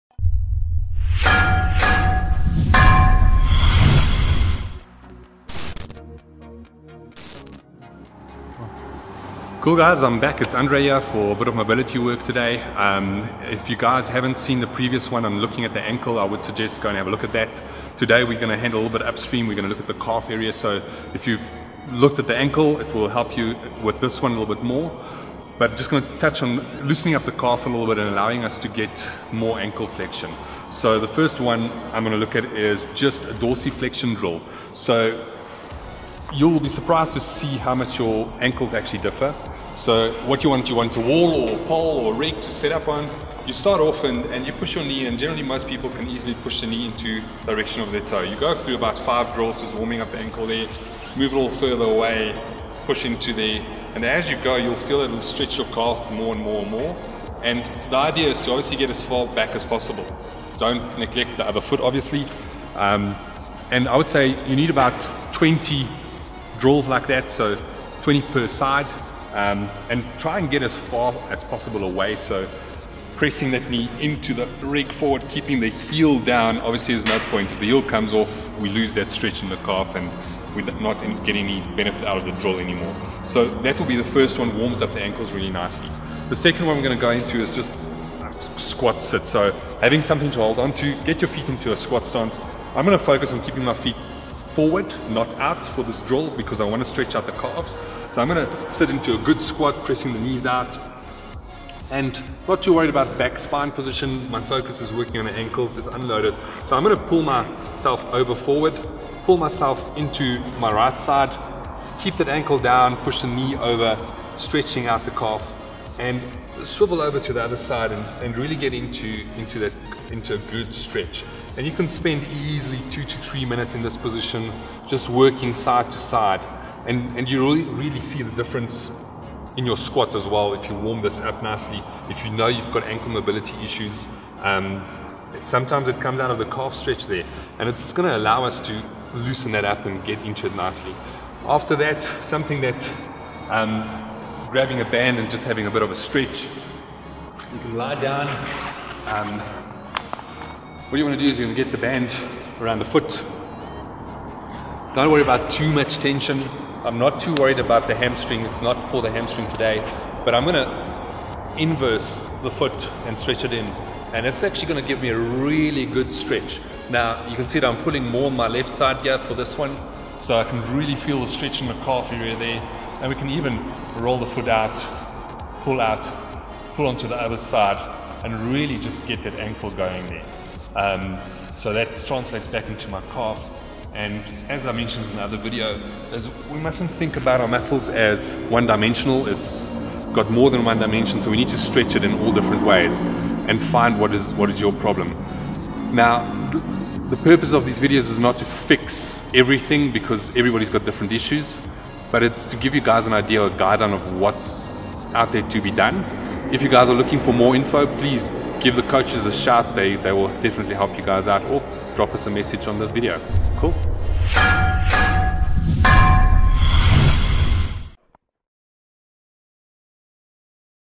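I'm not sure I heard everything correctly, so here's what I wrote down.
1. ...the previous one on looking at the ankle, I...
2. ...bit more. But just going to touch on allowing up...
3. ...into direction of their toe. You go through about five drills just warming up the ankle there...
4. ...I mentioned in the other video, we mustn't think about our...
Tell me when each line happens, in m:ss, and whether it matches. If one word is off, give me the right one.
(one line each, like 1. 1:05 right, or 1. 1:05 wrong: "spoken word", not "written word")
1. 0:14 right
2. 0:24 wrong: "loosening", not "allowing"
3. 0:46 right
4. 3:04 right.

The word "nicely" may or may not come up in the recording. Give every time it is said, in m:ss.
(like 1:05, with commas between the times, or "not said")
1:25, 2:11, 2:20.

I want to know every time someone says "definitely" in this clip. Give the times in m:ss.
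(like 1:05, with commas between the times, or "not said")
3:30.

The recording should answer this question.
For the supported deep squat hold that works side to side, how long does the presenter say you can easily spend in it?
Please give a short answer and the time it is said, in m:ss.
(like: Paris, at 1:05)
2 to 3 minutes, at 2:02.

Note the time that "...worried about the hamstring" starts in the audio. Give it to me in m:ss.
2:37.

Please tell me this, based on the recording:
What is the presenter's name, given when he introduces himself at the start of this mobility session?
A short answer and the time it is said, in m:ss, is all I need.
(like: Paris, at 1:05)
Andrea, at 0:10.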